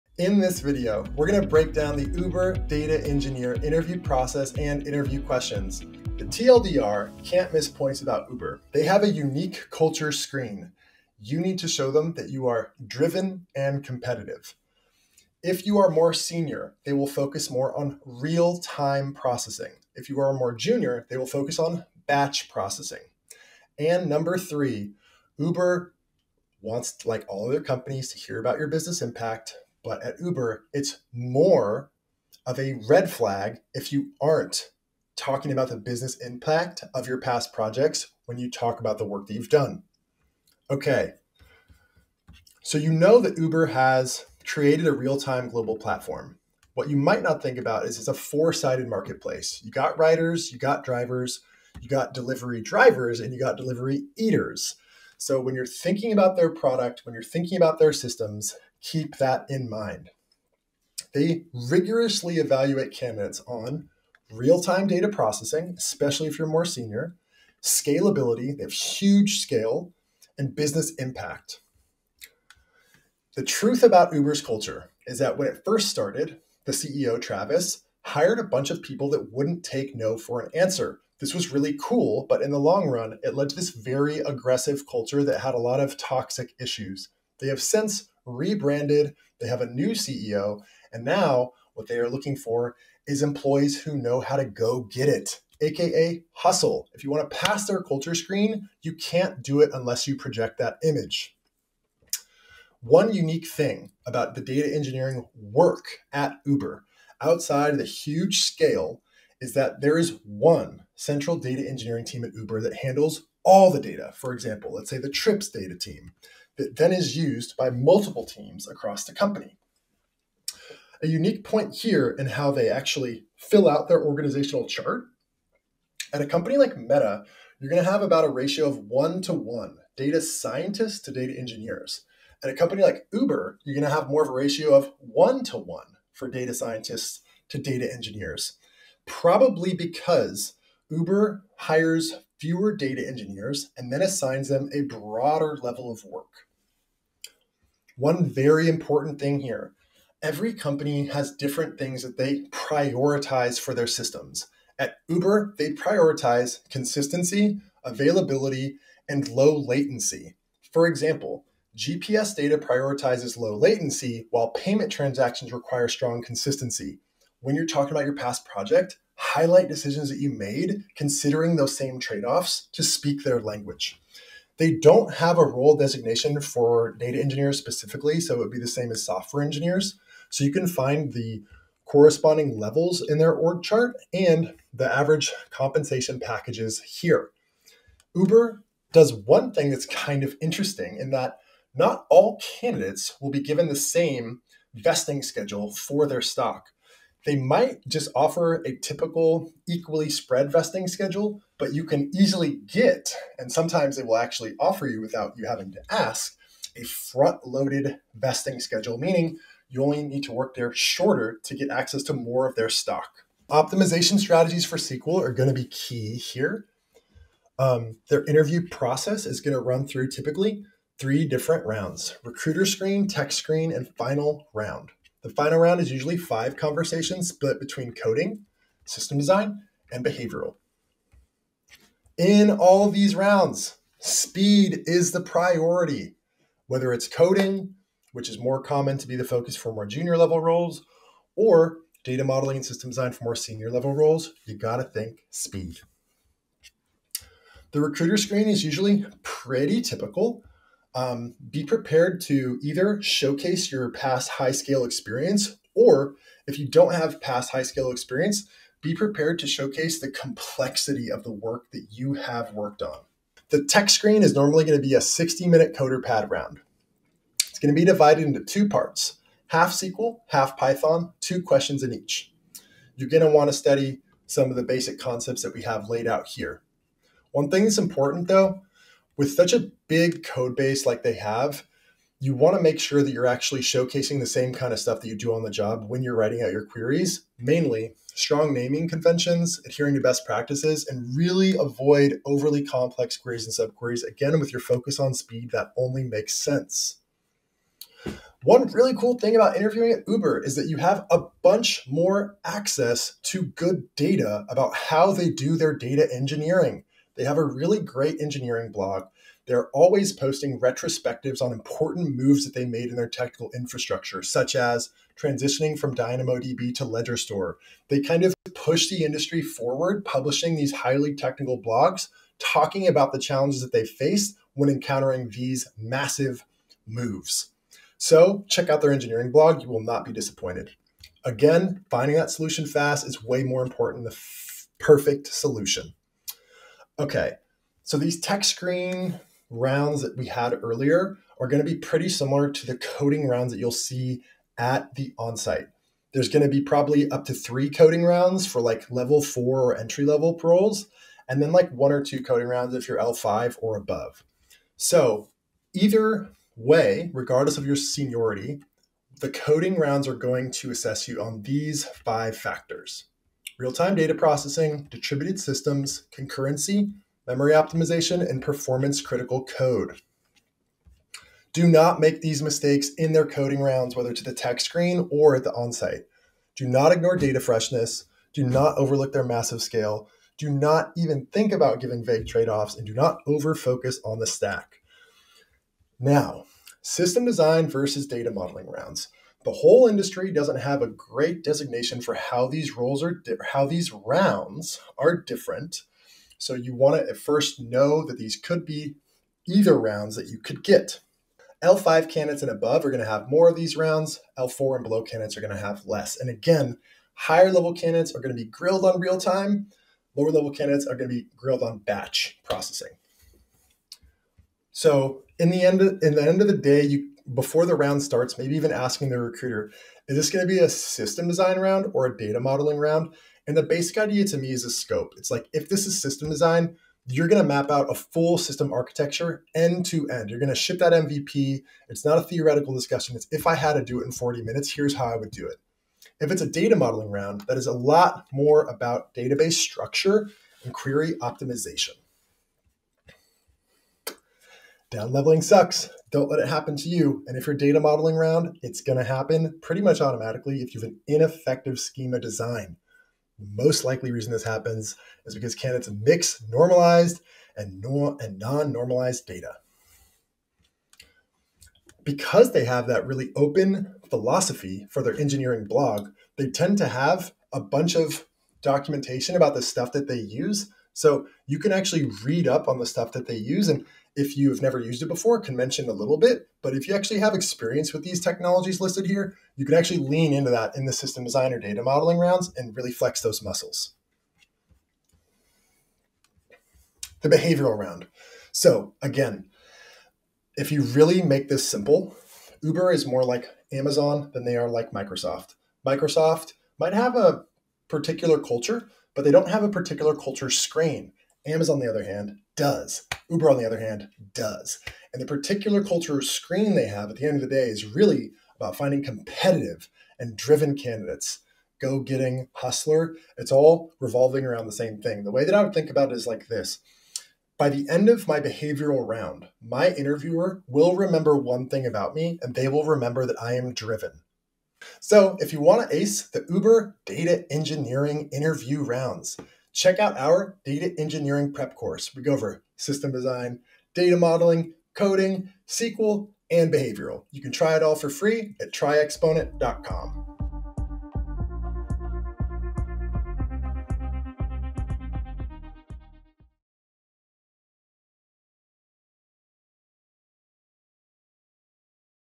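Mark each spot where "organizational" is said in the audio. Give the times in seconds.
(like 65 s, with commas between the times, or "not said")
124 s.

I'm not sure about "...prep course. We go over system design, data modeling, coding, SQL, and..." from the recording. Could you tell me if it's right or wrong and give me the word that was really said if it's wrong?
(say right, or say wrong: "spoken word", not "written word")
right.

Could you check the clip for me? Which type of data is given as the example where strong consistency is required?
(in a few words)
payment transactions.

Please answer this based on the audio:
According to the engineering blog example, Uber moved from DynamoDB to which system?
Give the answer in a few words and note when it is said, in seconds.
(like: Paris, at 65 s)
Ledger Store, at 316 s.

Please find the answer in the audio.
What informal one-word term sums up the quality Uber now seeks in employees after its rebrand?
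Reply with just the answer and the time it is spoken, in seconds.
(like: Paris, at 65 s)
hustle, at 96 s.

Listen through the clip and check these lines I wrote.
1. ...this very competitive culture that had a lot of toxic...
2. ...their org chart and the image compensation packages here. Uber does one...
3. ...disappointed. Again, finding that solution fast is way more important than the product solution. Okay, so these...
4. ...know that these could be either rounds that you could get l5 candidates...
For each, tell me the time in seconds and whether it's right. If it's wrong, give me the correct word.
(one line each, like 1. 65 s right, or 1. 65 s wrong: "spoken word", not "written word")
1. 83 s wrong: "aggressive", not "competitive"
2. 183 s wrong: "average", not "image"
3. 330 s wrong: "perfect", not "product"
4. 397 s right.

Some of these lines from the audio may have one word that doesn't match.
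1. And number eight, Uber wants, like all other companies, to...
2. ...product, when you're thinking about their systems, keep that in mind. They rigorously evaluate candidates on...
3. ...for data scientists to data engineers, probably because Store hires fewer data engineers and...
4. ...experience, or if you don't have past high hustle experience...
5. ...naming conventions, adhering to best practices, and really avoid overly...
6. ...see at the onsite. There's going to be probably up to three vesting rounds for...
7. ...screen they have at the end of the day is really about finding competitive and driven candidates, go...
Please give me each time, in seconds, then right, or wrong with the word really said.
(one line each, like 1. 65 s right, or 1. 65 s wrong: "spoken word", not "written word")
1. 23 s wrong: "three", not "eight"
2. 56 s right
3. 136 s wrong: "Uber", not "Store"
4. 254 s wrong: "scale", not "hustle"
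5. 288 s right
6. 343 s wrong: "coding", not "vesting"
7. 506 s right.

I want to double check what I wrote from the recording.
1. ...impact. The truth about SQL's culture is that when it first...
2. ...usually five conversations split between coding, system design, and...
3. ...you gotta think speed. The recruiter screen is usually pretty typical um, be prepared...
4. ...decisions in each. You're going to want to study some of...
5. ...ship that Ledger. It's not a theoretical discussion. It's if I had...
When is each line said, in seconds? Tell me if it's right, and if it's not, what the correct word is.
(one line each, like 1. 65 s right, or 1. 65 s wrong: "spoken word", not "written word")
1. 70 s wrong: "Uber", not "SQL"
2. 225 s right
3. 244 s right
4. 271 s wrong: "questions", not "decisions"
5. 430 s wrong: "MVP", not "Ledger".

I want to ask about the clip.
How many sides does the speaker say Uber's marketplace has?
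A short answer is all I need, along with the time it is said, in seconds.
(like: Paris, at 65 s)
4, at 48 s.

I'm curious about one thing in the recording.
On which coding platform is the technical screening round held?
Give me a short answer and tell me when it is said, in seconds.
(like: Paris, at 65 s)
CoderPad, at 265 s.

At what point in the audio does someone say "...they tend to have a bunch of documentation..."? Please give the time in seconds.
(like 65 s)
466 s.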